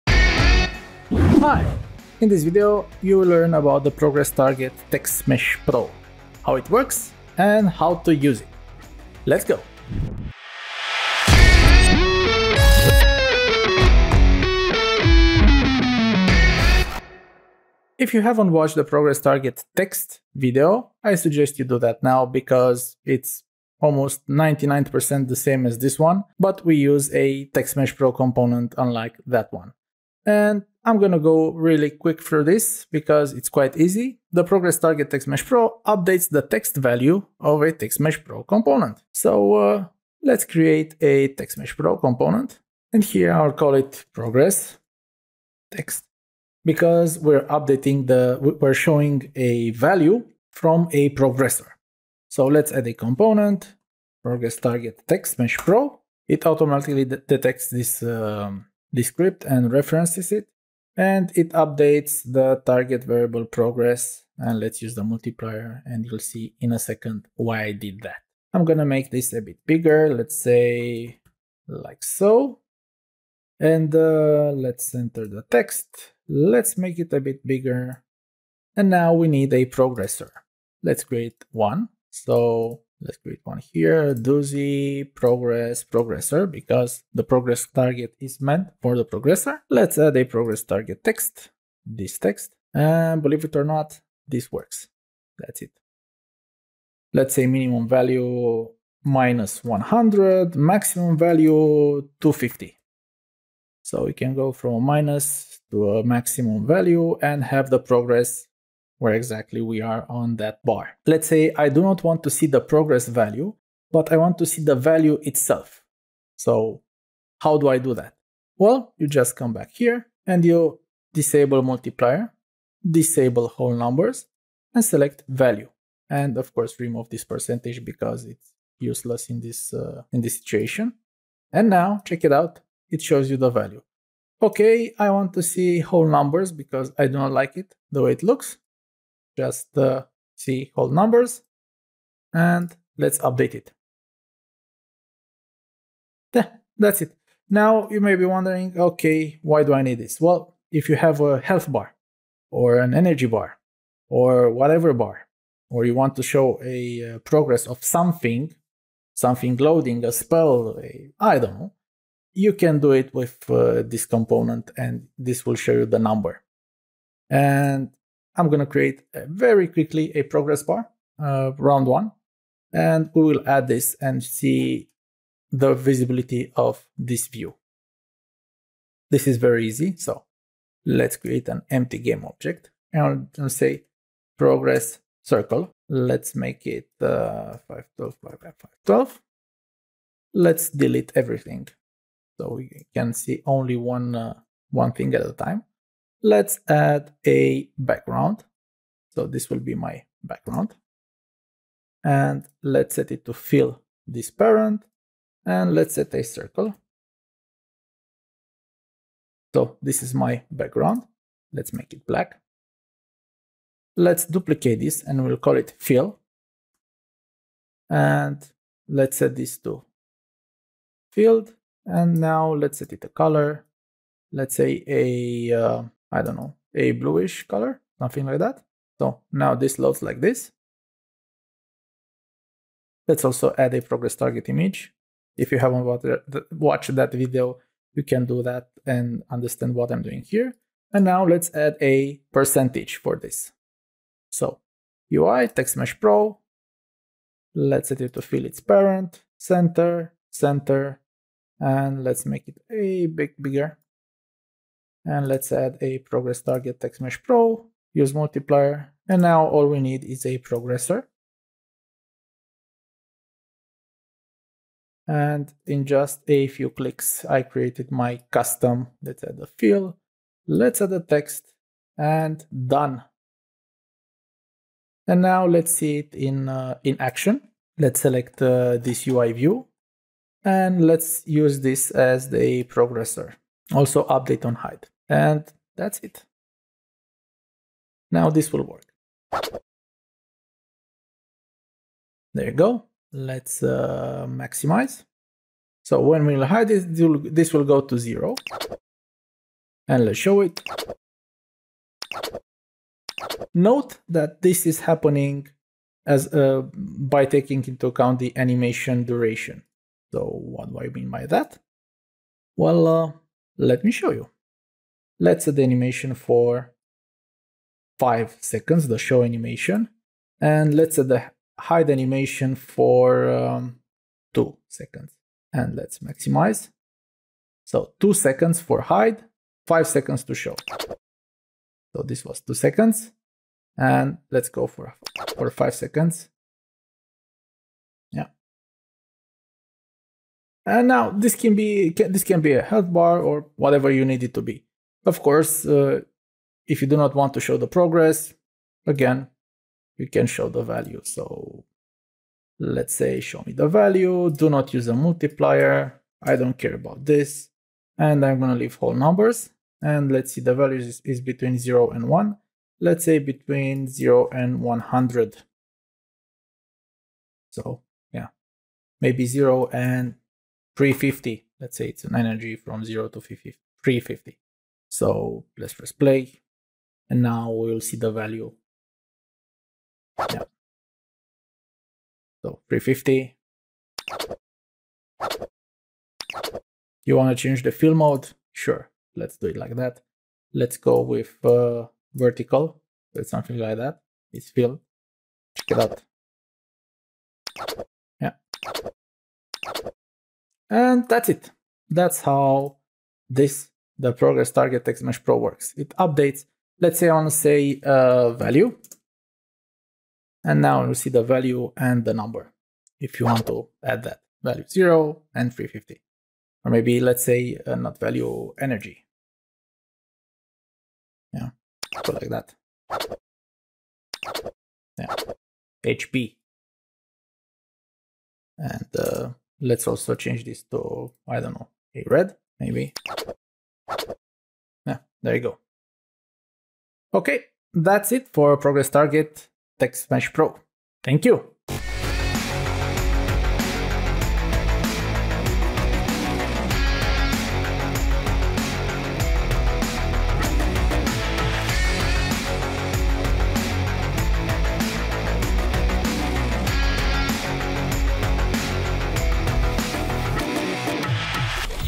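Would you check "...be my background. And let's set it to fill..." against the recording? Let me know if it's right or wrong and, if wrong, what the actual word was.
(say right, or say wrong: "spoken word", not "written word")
right.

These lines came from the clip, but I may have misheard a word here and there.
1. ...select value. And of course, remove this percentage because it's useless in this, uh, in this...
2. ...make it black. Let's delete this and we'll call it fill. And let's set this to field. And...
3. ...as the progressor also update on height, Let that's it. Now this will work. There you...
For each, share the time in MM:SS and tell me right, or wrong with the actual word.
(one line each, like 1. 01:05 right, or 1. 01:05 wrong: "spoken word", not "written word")
1. 02:04 right
2. 03:31 wrong: "duplicate", not "delete"
3. 04:41 wrong: "And", not "Let".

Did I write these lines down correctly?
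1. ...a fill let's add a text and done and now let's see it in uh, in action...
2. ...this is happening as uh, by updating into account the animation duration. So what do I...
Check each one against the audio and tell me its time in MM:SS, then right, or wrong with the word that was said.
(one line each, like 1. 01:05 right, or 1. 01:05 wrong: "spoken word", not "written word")
1. 04:29 right
2. 05:04 wrong: "taking", not "updating".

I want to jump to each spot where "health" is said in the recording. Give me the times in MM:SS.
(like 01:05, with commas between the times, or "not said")
02:31, 05:42.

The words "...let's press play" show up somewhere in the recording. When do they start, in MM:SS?
06:15.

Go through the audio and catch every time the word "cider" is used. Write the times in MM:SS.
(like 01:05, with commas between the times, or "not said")
not said.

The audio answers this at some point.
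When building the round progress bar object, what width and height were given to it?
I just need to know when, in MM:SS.
03:07.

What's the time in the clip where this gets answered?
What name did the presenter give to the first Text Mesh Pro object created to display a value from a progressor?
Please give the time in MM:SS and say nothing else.
00:44.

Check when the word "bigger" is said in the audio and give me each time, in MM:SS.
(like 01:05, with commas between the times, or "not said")
01:09, 01:17, 04:13.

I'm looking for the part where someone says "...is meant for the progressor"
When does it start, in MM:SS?
01:28.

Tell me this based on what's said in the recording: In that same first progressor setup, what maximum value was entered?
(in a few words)
250.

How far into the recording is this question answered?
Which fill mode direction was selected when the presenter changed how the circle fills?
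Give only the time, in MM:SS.
06:32.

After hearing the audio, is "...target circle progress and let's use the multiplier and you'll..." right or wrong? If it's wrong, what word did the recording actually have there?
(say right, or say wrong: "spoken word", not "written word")
wrong: "variable", not "circle".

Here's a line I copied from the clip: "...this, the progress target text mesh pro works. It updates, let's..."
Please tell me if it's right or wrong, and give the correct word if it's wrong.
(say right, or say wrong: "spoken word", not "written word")
right.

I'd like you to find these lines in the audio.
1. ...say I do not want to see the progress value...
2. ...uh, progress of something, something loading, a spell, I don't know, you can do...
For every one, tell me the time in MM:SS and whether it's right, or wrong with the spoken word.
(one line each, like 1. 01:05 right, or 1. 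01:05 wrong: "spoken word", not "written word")
1. 01:51 right
2. 02:37 right.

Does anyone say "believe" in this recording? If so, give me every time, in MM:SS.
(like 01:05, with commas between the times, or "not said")
01:33.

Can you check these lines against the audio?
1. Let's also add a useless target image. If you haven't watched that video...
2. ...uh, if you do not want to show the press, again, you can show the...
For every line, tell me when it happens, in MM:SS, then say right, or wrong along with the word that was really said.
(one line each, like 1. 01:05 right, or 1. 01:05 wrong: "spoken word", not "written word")
1. 03:53 wrong: "progress", not "useless"
2. 05:45 wrong: "progress", not "press".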